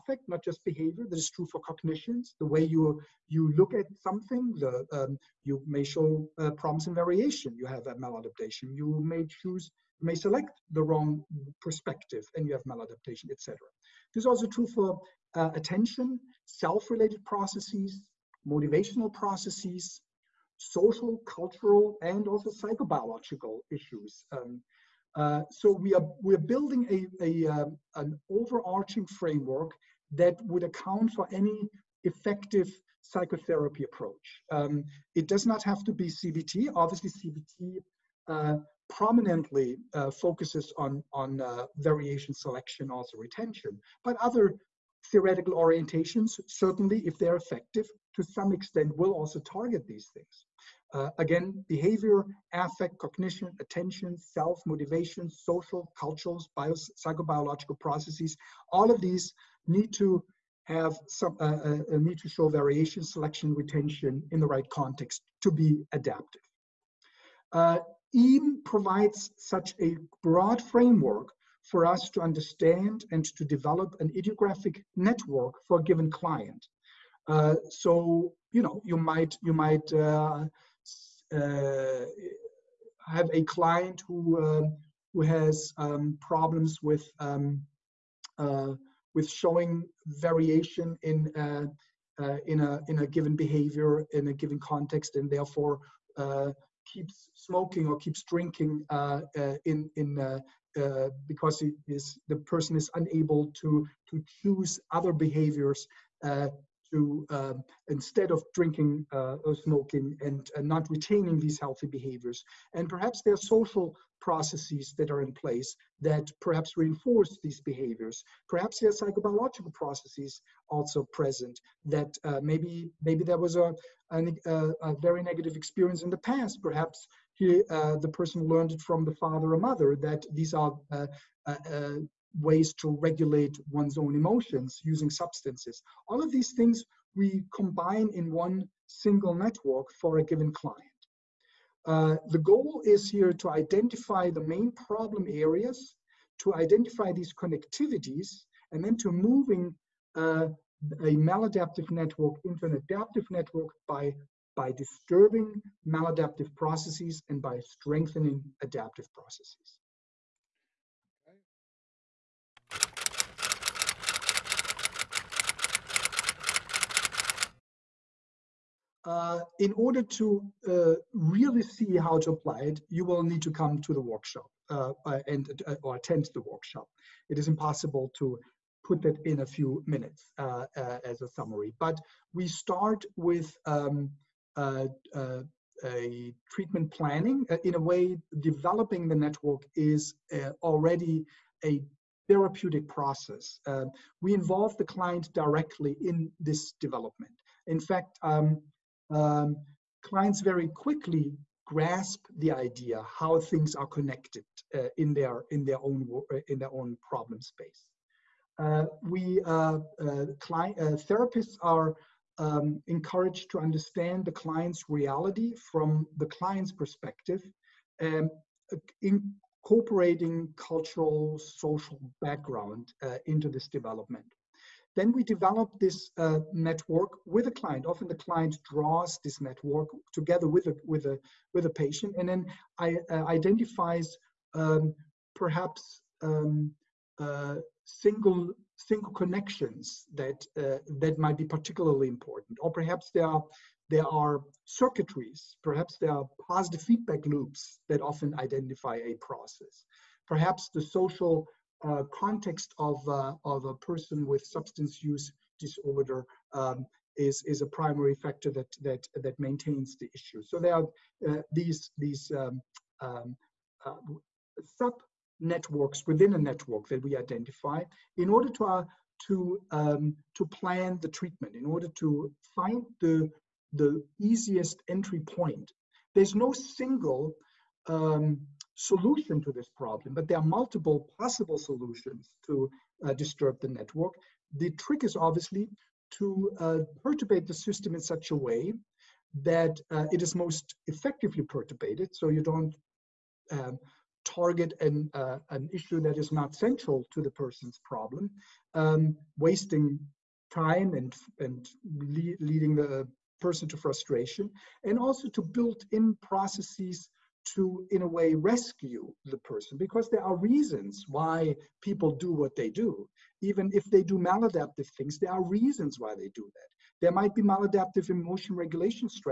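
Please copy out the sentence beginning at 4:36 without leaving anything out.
There's no single um, solution to this problem, but there are multiple possible solutions to uh, disturb the network.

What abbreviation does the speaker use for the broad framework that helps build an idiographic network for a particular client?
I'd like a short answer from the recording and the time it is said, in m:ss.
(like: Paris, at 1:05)
EAM, at 1:08.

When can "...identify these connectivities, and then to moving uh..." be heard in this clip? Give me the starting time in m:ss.
2:26.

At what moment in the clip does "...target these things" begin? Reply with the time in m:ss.
0:49.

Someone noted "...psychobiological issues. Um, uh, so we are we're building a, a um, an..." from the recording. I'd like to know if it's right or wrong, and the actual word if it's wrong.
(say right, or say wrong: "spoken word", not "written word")
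right.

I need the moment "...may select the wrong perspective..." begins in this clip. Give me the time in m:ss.
0:10.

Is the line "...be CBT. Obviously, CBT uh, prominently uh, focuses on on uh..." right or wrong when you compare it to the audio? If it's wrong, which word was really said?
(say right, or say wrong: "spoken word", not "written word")
right.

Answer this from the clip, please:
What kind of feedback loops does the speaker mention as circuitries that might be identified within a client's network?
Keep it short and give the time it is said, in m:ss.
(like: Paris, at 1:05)
positive feedback loops, at 4:06.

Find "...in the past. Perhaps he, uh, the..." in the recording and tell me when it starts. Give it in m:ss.
2:06.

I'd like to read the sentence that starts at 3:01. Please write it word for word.
But we start with um, a treatment planning.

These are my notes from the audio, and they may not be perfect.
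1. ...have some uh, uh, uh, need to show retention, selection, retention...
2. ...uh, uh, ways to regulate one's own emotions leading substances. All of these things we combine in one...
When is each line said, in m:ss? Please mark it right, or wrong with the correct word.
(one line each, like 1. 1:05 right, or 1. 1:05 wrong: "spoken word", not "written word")
1. 1:00 wrong: "variation", not "retention"
2. 2:11 wrong: "using", not "leading".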